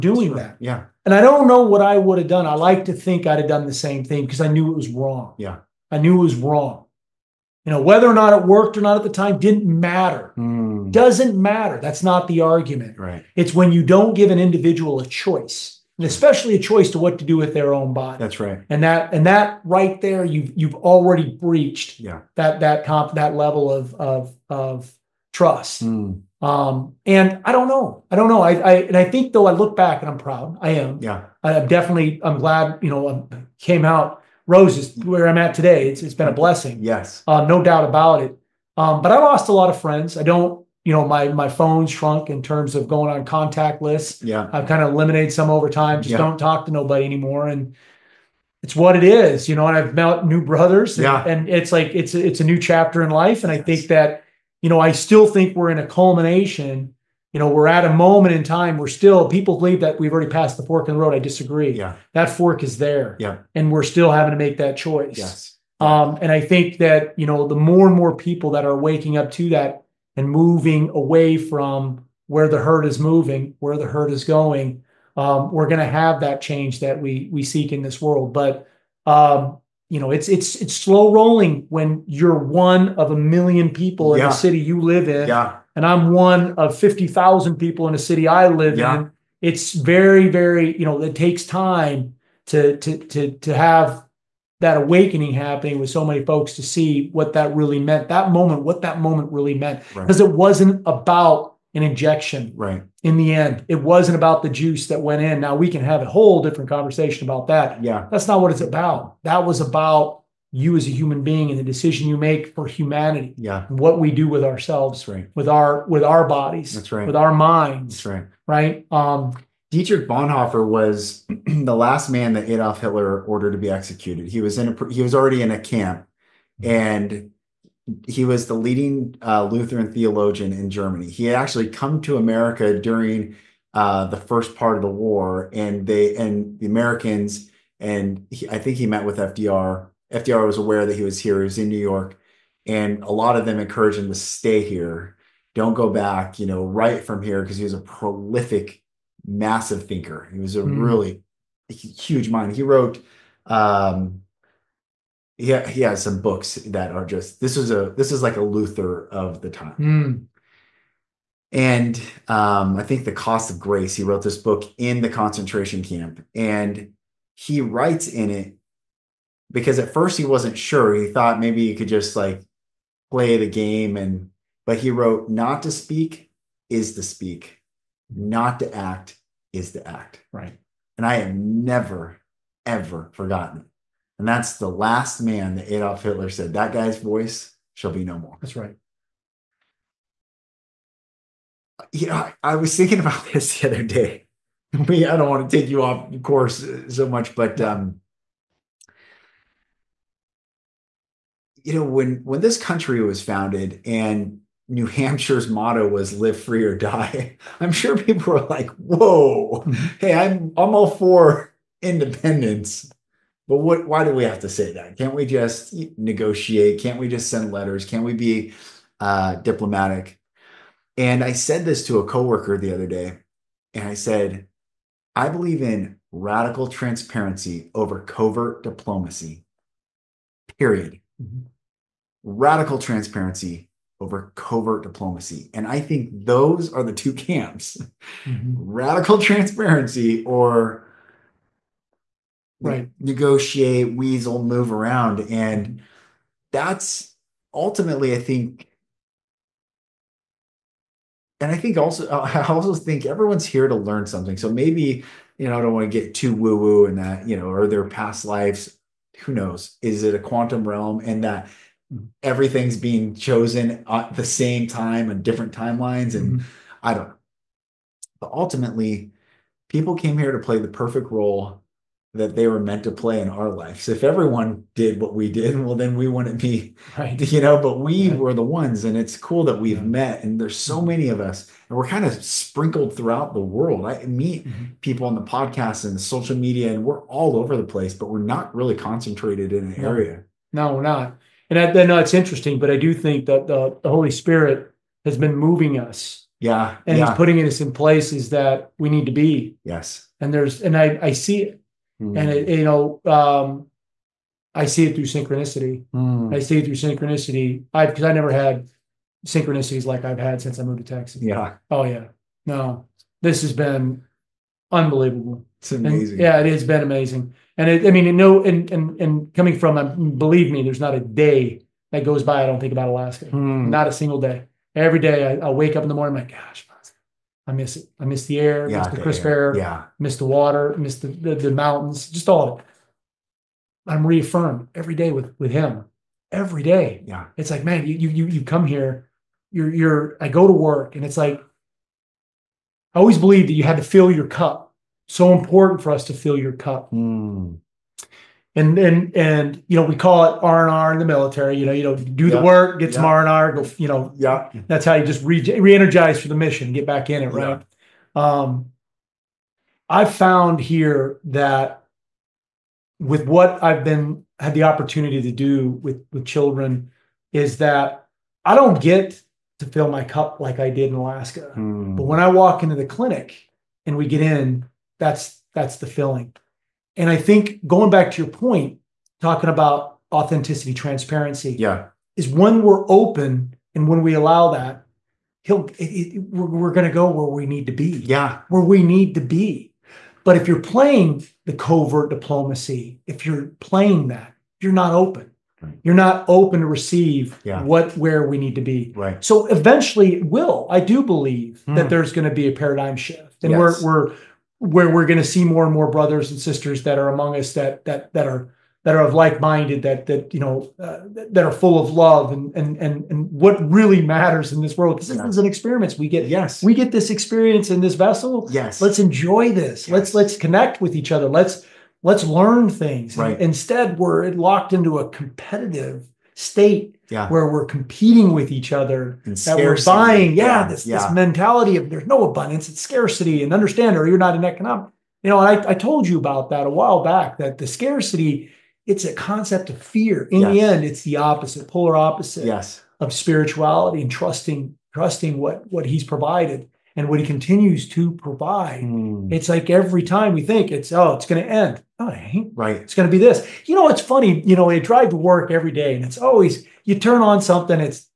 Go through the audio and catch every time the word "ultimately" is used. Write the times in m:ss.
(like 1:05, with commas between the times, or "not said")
4:07, 4:28.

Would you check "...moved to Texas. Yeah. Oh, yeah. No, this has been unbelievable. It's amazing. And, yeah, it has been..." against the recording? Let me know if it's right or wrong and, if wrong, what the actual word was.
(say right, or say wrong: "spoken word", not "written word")
right.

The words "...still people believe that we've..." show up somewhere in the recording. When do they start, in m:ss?
0:58.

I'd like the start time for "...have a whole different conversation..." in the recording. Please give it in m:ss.
1:45.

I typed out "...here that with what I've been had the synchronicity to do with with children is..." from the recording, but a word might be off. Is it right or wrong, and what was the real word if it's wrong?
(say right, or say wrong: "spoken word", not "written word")
wrong: "opportunity", not "synchronicity".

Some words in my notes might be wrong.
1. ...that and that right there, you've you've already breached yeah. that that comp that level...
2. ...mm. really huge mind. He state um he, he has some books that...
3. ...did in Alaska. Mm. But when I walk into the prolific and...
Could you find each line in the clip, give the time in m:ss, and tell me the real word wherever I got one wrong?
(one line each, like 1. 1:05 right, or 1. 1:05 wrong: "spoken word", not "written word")
1. 0:18 right
2. 2:30 wrong: "wrote", not "state"
3. 6:10 wrong: "clinic", not "prolific".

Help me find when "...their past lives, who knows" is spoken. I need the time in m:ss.
4:17.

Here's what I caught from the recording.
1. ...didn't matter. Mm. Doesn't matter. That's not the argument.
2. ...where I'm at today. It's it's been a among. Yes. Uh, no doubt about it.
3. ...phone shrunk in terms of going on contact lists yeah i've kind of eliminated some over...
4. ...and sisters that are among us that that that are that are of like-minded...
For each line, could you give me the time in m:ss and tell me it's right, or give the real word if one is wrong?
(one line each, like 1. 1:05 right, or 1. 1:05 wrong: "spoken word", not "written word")
1. 0:09 right
2. 0:35 wrong: "blessing", not "among"
3. 0:41 right
4. 6:46 right.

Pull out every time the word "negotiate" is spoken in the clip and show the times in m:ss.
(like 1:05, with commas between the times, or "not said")
3:35, 4:02.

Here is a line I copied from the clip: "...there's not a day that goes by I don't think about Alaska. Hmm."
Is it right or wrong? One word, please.
right.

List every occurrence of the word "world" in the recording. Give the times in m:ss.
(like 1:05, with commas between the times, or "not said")
1:18, 4:43, 6:54.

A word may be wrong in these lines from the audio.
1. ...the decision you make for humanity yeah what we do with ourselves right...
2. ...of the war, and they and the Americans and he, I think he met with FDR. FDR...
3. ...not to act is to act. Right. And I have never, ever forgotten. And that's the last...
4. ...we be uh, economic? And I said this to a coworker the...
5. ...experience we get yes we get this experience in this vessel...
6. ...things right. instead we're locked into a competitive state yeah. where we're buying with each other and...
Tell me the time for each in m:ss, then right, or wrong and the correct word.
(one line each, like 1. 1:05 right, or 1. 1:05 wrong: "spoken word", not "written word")
1. 1:51 right
2. 2:14 right
3. 2:58 right
4. 3:38 wrong: "diplomatic", not "economic"
5. 6:55 right
6. 7:02 wrong: "competing", not "buying".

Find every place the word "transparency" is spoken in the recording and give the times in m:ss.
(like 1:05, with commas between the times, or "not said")
3:46, 3:52, 3:59, 6:20.